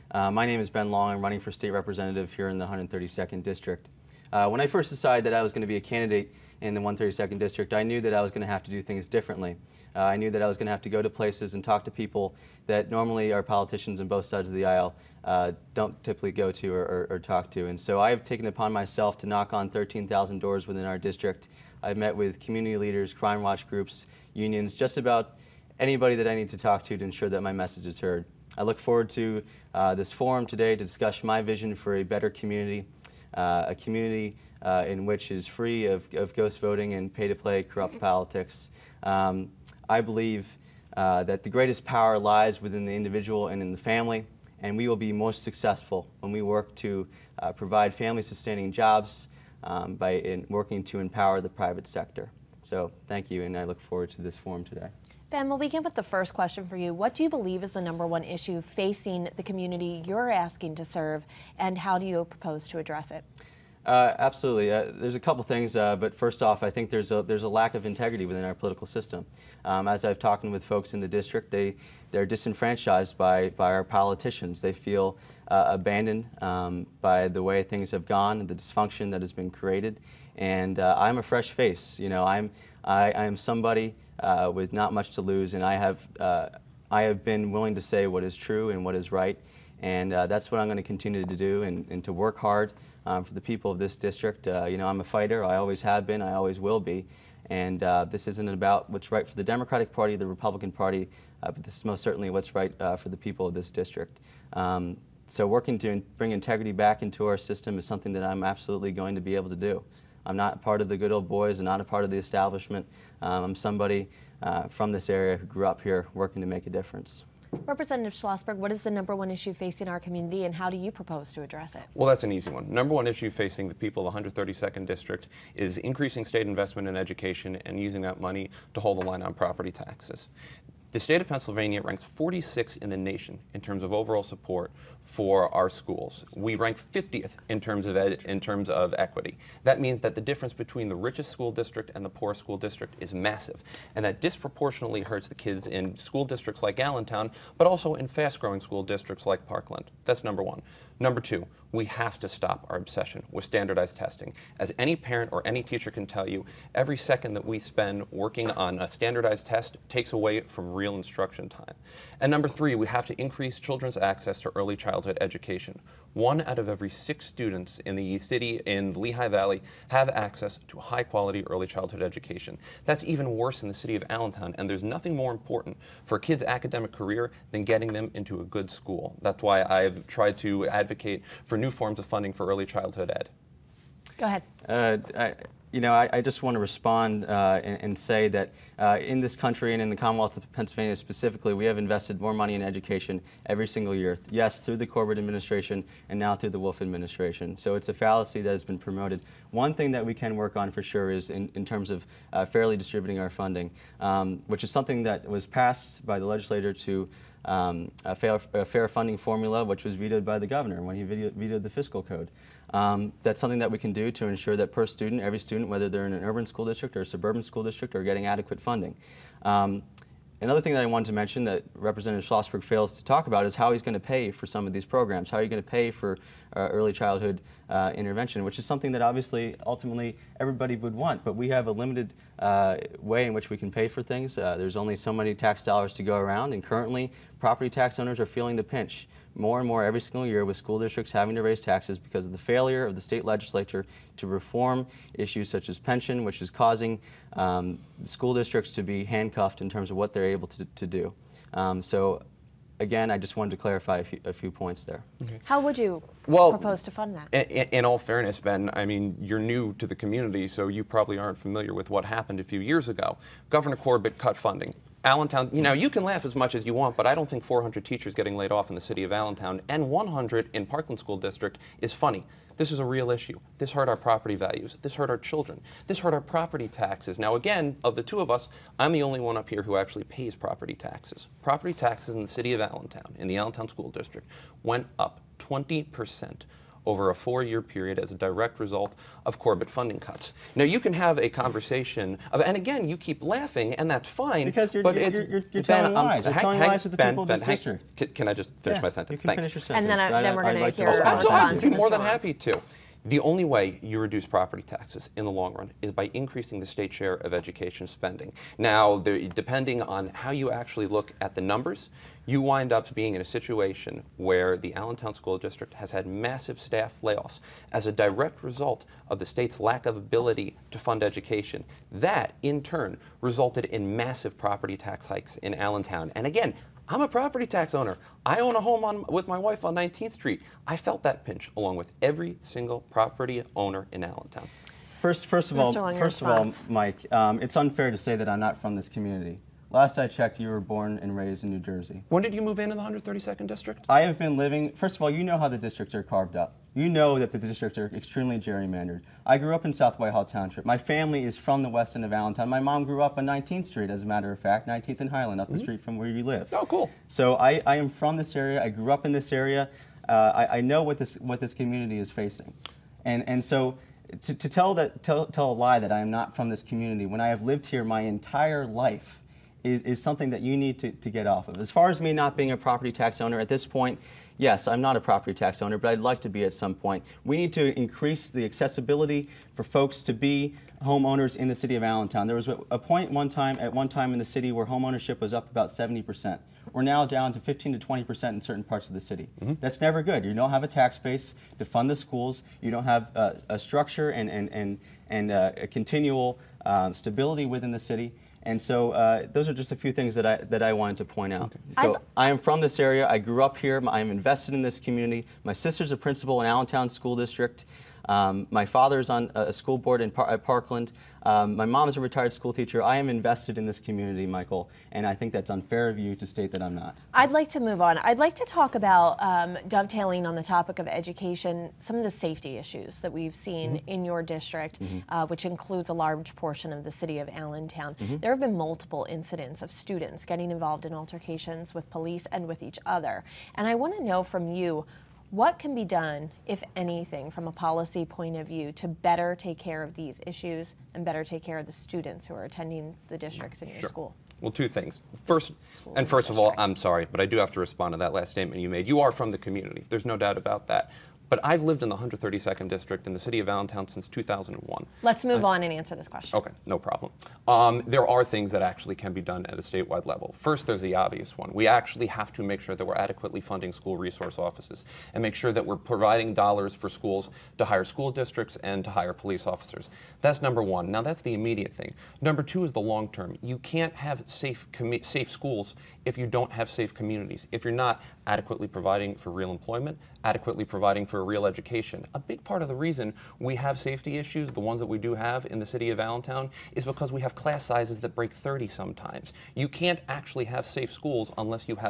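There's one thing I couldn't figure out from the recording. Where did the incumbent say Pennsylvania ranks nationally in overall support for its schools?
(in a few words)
46th.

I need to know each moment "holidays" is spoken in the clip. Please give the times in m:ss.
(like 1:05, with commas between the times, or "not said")
not said.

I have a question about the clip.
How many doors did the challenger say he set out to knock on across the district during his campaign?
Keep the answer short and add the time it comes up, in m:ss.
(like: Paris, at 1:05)
13,000, at 0:19.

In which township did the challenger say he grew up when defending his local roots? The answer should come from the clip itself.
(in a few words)
South Whitehall Township.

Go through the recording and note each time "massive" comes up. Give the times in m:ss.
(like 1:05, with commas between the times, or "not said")
2:23, 5:16, 5:23.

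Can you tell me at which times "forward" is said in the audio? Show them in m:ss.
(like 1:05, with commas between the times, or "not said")
0:28, 0:53.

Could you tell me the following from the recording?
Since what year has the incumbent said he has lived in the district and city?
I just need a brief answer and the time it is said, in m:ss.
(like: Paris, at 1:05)
2001, at 7:34.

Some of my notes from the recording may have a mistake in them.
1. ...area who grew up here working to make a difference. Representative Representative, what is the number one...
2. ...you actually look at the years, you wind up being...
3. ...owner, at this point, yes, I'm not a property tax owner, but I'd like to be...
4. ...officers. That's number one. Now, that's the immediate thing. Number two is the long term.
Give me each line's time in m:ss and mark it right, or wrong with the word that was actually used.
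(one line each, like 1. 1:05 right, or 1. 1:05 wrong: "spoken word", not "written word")
1. 1:55 wrong: "Schlossberg", not "Representative"
2. 5:10 wrong: "numbers", not "years"
3. 6:13 right
4. 7:49 right.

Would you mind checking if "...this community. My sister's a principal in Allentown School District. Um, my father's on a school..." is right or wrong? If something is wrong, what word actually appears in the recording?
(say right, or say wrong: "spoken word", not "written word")
right.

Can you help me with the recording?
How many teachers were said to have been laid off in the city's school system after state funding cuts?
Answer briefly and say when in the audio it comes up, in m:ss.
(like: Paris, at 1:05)
400, at 4:27.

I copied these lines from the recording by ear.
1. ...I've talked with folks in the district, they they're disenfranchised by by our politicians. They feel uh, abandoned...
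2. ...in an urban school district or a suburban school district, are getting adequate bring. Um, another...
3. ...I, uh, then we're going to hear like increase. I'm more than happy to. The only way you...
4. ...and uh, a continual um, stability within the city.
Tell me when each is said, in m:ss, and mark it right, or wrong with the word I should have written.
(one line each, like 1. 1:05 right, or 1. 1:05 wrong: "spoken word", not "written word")
1. 1:10 right
2. 3:36 wrong: "funding", not "bring"
3. 5:00 wrong: "response", not "increase"
4. 6:35 right.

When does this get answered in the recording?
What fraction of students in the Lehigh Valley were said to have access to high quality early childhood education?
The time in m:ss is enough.
2:46.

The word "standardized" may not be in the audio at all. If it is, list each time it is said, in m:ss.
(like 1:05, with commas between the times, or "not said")
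2:33, 2:38.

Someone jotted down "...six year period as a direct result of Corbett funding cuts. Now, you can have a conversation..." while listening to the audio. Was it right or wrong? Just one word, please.
wrong.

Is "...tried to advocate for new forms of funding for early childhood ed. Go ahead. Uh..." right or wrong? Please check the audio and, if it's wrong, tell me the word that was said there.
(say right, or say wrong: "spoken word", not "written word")
right.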